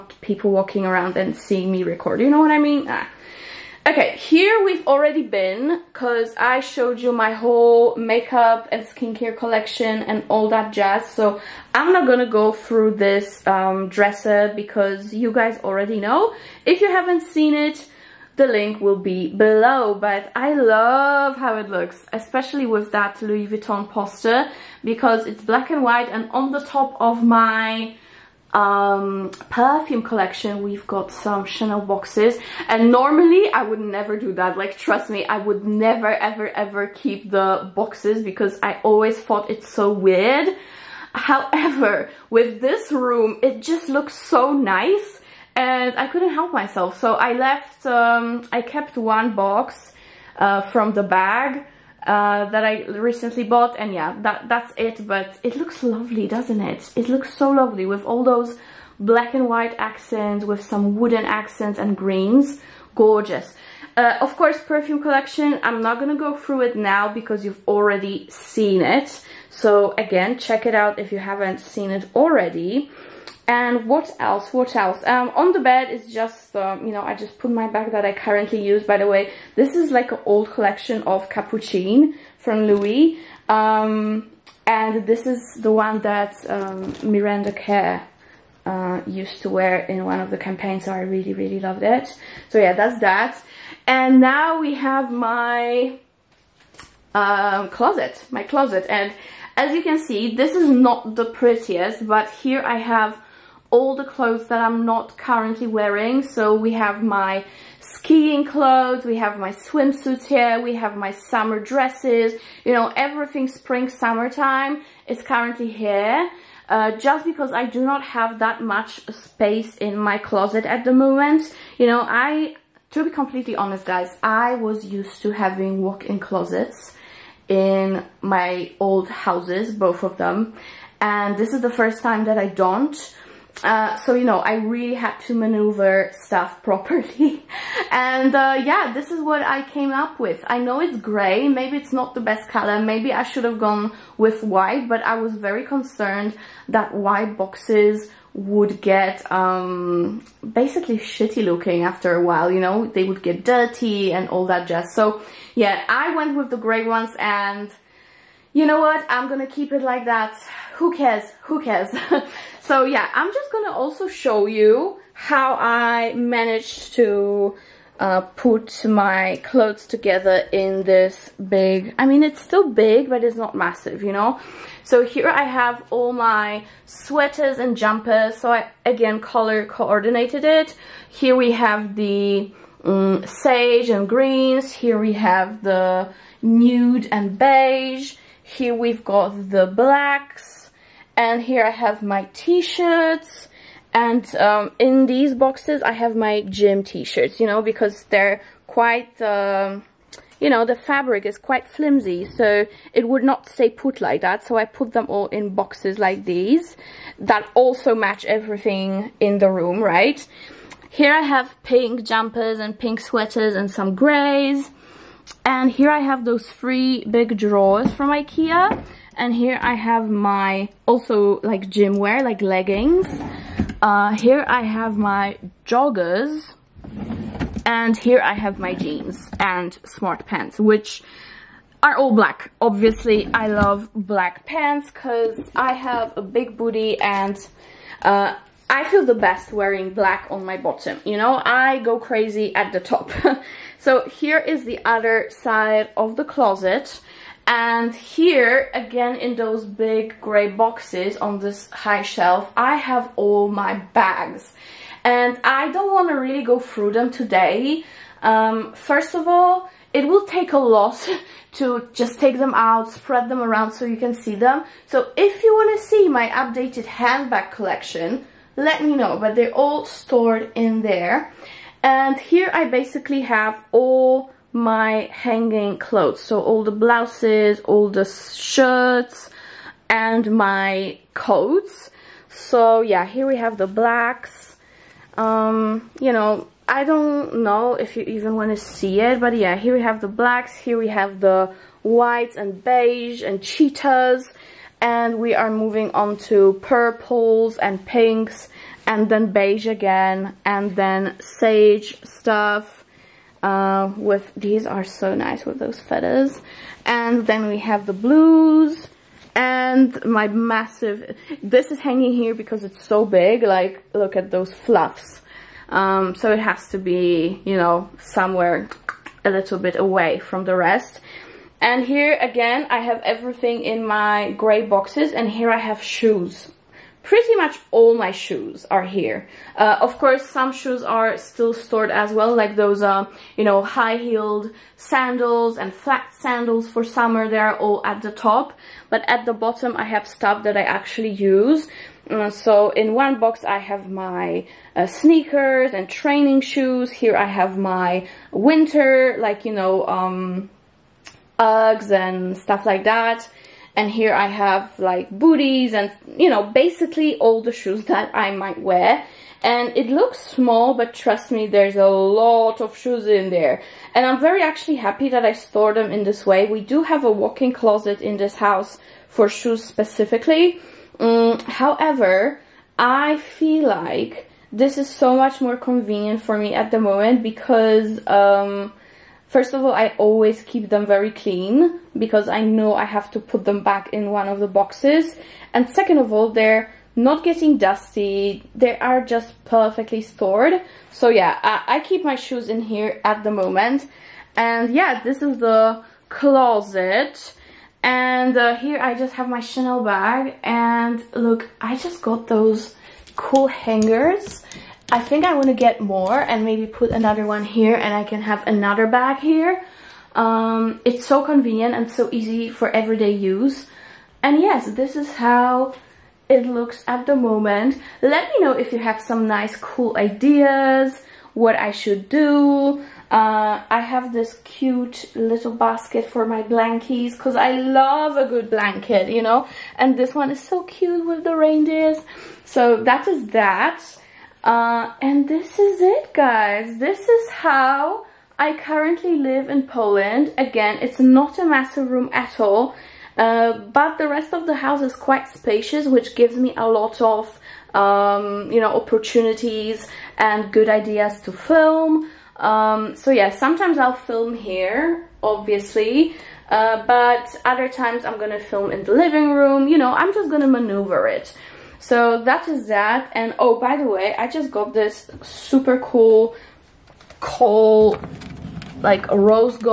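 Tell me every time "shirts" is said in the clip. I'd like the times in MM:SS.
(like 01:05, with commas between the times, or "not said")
03:12, 03:16, 04:38.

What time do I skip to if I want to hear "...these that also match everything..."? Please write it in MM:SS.
03:26.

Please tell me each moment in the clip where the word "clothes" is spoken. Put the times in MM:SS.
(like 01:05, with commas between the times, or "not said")
01:44, 01:48, 02:49, 04:35.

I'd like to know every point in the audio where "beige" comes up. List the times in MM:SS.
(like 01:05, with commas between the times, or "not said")
03:07, 04:52, 04:59.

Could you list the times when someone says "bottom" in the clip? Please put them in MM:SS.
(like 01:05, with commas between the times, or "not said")
04:00, 05:39.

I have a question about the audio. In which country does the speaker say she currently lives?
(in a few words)
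Poland.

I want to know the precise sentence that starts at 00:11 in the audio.
So I'm not gonna go through this um, dresser because you guys already know.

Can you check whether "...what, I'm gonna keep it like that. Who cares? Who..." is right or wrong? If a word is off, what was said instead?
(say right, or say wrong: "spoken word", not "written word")
right.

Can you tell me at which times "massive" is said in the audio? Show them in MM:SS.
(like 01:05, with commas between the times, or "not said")
02:53, 05:10, 07:21.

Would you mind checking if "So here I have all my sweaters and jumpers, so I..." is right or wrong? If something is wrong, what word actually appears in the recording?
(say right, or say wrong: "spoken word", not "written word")
right.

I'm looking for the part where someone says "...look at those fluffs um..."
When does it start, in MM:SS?
05:13.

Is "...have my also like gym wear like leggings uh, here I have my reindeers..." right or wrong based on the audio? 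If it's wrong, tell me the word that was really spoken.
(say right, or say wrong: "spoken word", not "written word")
wrong: "joggers", not "reindeers".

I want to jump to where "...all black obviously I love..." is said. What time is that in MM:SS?
03:51.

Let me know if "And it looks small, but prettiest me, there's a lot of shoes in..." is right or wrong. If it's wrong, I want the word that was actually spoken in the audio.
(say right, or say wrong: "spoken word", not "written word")
wrong: "trust", not "prettiest".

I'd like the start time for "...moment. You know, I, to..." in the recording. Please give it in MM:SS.
02:00.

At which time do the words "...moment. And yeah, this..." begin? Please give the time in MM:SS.
06:33.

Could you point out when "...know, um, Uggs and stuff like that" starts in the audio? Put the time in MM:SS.
05:49.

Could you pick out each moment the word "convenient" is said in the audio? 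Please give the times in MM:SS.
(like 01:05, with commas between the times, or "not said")
06:15, 06:51.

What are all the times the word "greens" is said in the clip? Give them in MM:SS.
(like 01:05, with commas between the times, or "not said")
01:01, 03:04.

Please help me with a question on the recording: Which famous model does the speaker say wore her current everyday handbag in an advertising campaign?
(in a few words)
Miranda Kerr.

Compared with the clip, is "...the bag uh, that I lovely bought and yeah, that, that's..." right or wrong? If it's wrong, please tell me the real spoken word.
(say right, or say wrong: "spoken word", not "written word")
wrong: "recently", not "lovely".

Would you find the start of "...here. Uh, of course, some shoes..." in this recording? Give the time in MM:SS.
05:28.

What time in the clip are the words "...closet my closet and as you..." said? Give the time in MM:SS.
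01:37.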